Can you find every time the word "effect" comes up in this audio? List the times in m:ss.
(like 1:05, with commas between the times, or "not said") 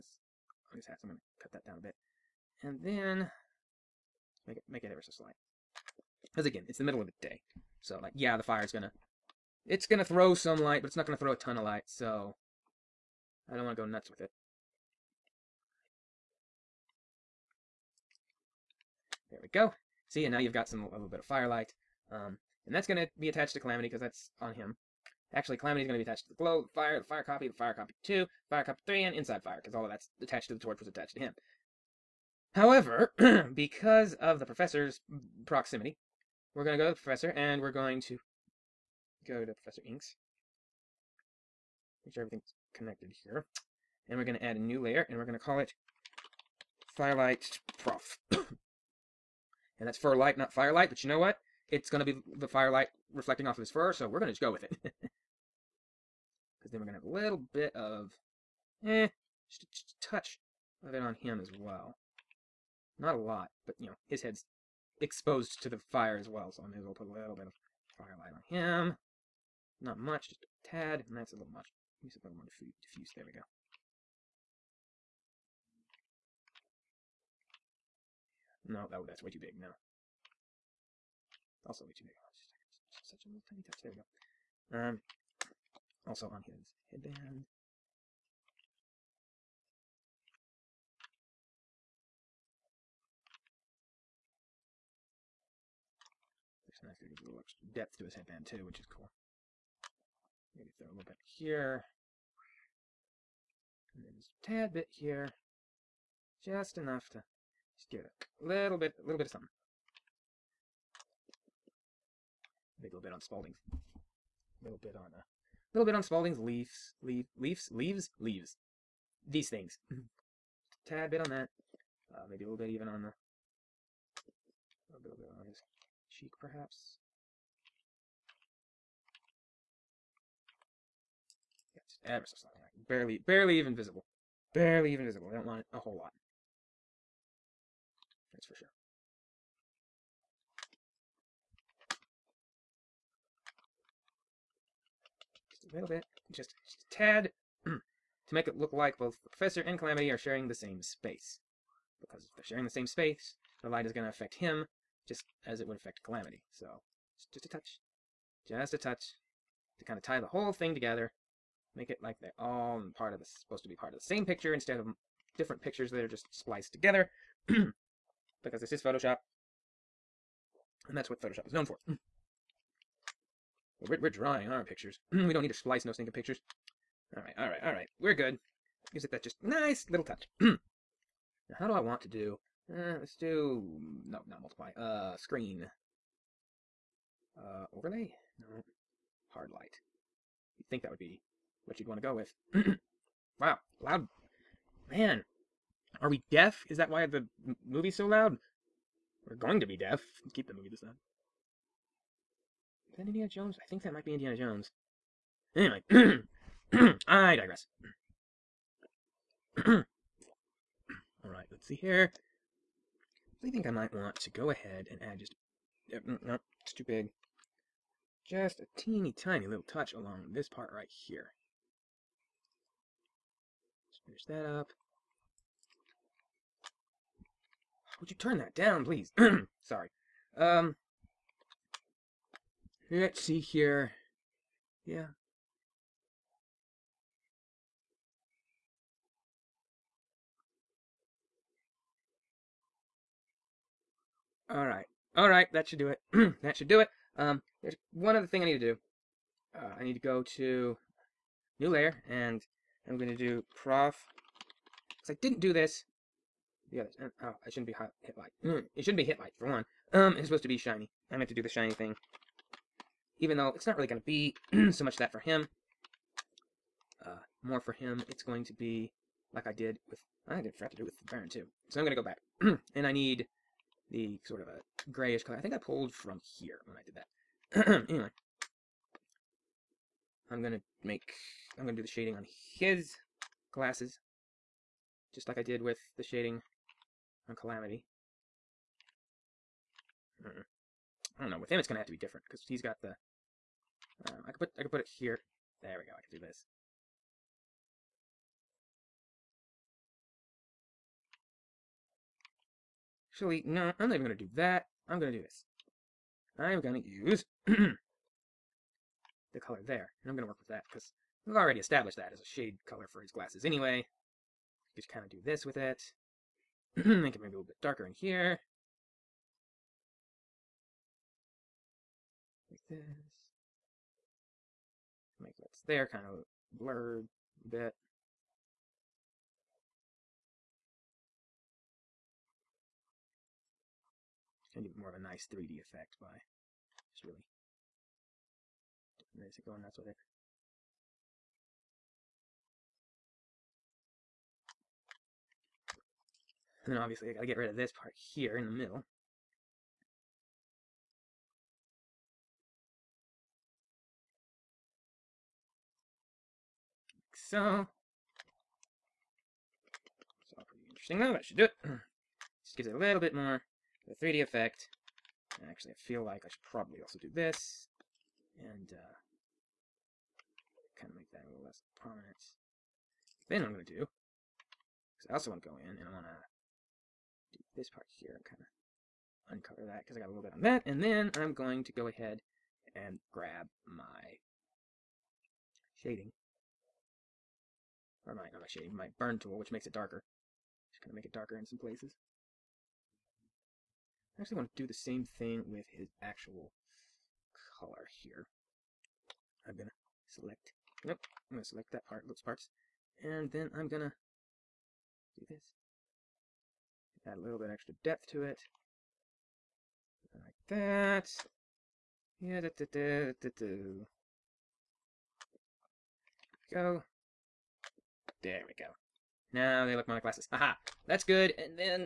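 5:35, 6:04.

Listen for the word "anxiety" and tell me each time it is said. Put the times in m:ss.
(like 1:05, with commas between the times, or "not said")
not said.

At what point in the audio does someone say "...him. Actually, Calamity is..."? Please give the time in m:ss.
0:24.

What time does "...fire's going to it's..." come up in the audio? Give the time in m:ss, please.
0:08.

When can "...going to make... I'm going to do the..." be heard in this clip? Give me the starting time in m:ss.
4:40.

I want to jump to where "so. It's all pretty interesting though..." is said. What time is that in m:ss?
5:57.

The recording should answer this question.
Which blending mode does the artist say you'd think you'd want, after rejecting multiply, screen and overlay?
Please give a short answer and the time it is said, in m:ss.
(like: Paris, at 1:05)
Hard light, at 3:09.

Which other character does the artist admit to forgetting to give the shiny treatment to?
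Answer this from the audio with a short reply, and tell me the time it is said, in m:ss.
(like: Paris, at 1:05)
The Baron, at 4:30.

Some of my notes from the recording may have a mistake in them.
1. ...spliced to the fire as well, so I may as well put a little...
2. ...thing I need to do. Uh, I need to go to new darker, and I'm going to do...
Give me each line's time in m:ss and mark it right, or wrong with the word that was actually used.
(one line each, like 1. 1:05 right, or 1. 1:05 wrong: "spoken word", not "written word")
1. 1:05 wrong: "exposed", not "spliced"
2. 4:08 wrong: "layer", not "darker".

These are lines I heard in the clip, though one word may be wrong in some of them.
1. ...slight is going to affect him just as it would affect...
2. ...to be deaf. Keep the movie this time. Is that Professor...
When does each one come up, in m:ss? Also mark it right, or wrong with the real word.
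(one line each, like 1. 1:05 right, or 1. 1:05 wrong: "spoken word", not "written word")
1. 2:33 wrong: "light", not "slight"
2. 3:19 wrong: "Indiana", not "Professor".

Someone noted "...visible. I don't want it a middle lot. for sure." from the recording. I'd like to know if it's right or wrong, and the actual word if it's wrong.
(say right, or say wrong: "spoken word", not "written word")
wrong: "whole", not "middle".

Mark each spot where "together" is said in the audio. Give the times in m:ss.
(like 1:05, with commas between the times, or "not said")
2:40, 2:46.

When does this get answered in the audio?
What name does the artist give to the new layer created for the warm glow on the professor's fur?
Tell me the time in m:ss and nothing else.
0:46.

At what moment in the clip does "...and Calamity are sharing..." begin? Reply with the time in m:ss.
2:29.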